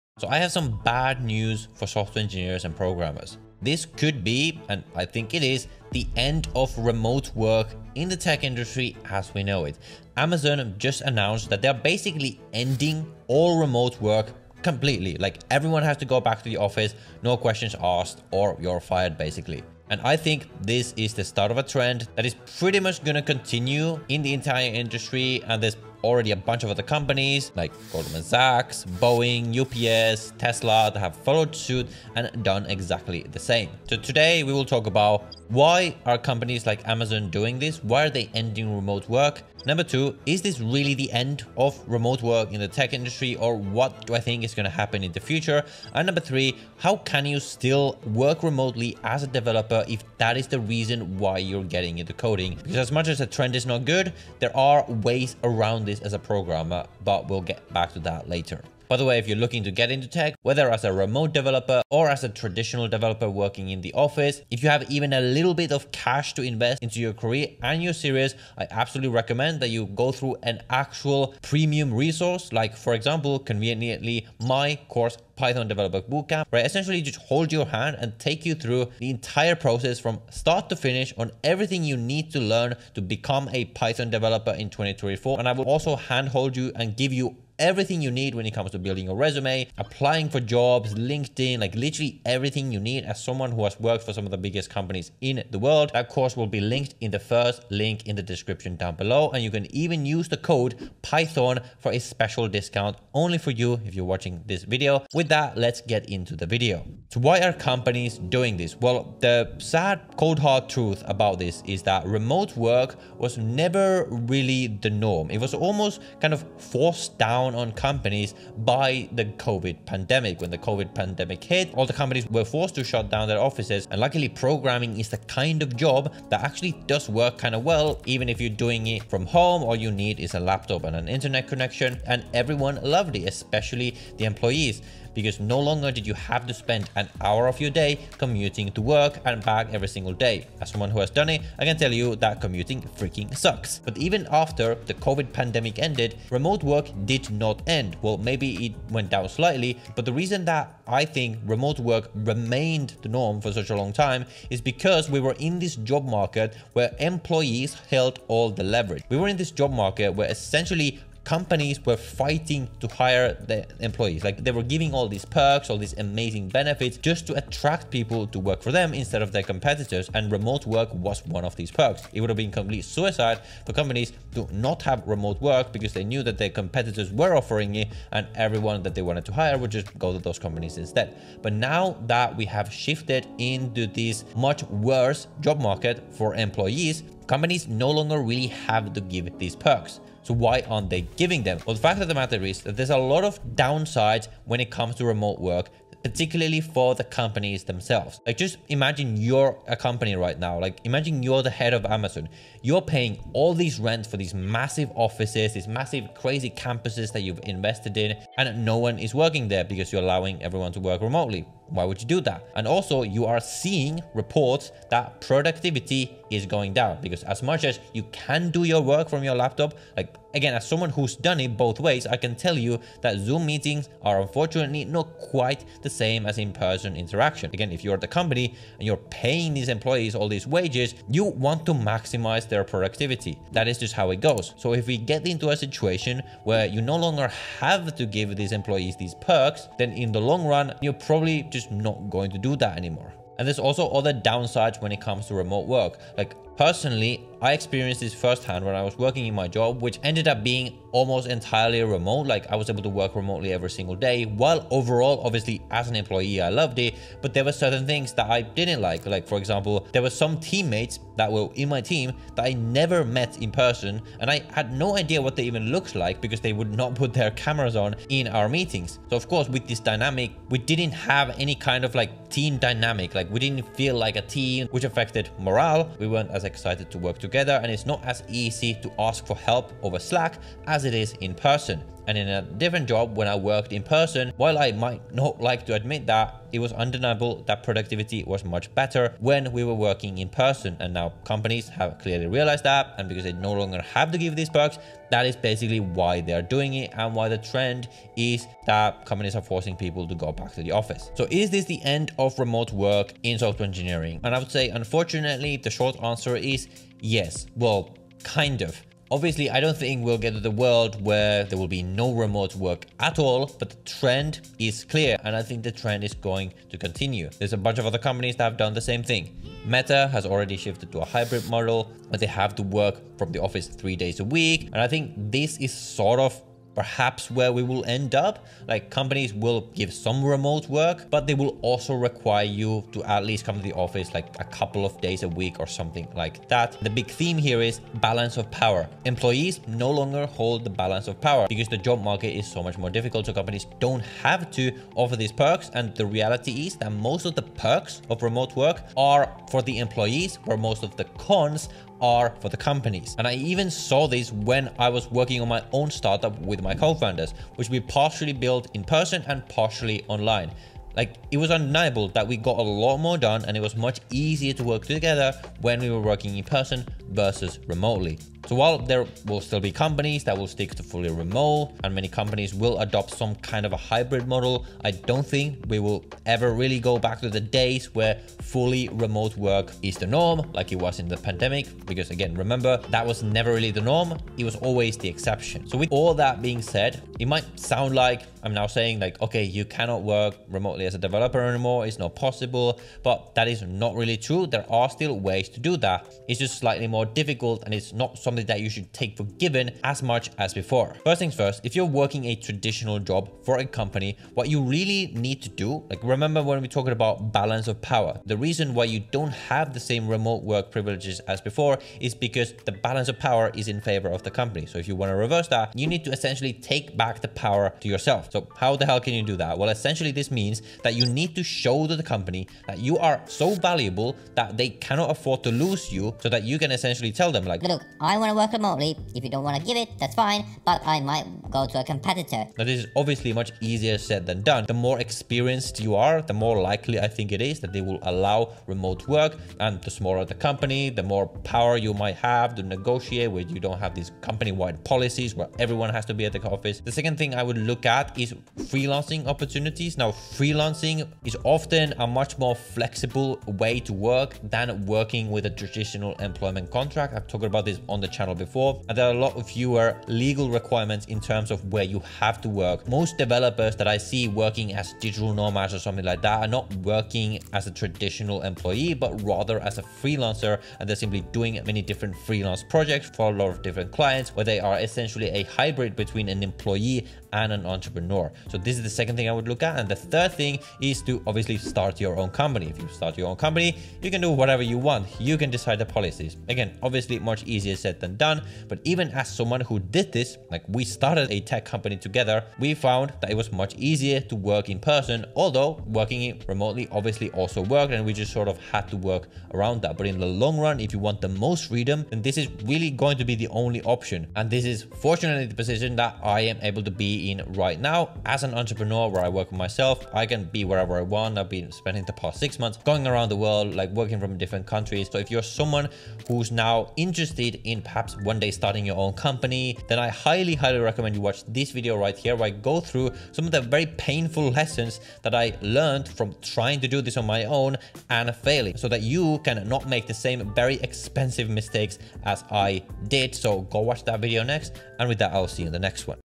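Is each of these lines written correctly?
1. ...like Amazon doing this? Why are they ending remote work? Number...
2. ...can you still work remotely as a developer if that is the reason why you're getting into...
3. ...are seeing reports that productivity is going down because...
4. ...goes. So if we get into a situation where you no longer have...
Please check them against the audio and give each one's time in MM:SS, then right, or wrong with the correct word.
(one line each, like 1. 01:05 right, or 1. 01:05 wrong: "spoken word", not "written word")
1. 00:36 right
2. 00:46 right
3. 03:33 right
4. 03:54 right.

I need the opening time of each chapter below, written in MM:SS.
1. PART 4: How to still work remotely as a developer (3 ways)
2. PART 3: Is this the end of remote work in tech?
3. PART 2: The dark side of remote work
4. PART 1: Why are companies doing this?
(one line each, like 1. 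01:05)
1. 06:26
2. 05:02
3. 03:13
4. 01:26.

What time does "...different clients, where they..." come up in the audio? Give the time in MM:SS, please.
07:53.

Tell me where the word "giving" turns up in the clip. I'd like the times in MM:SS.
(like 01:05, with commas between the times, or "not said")
02:44, 03:11.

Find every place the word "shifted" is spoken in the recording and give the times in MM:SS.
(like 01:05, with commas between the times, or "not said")
03:02, 05:20.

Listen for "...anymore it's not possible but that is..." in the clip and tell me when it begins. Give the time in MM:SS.
06:31.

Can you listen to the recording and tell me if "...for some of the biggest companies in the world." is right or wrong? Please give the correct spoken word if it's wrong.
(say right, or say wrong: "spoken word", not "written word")
right.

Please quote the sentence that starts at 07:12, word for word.
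Now, this is obviously much easier said than done.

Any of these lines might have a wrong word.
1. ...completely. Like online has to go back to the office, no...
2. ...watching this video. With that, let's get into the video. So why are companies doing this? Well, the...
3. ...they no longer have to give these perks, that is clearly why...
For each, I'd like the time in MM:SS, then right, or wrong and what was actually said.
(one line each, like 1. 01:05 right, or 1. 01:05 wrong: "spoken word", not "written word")
1. 00:14 wrong: "everyone", not "online"
2. 01:44 right
3. 04:53 wrong: "basically", not "clearly".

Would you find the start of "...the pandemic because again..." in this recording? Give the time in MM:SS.
06:21.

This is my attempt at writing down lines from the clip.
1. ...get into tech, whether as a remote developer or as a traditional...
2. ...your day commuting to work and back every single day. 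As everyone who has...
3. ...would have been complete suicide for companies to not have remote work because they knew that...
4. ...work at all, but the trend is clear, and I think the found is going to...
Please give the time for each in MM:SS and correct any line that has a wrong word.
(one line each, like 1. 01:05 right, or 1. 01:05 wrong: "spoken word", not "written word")
1. 00:59 right
2. 02:17 wrong: "someone", not "everyone"
3. 02:52 right
4. 05:12 wrong: "trend", not "found".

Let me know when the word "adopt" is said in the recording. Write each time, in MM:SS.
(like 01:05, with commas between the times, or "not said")
06:12.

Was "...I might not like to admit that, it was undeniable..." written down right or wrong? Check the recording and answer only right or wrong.
right.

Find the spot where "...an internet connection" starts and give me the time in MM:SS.
02:10.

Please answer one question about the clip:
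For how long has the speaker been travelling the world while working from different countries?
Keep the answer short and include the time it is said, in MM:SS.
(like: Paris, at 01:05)
six months, at 08:32.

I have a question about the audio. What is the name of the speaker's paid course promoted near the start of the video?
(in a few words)
Python Developer Bootcamp.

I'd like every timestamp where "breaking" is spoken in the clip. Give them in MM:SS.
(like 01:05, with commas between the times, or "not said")
not said.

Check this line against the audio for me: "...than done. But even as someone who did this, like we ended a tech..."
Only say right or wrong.
wrong.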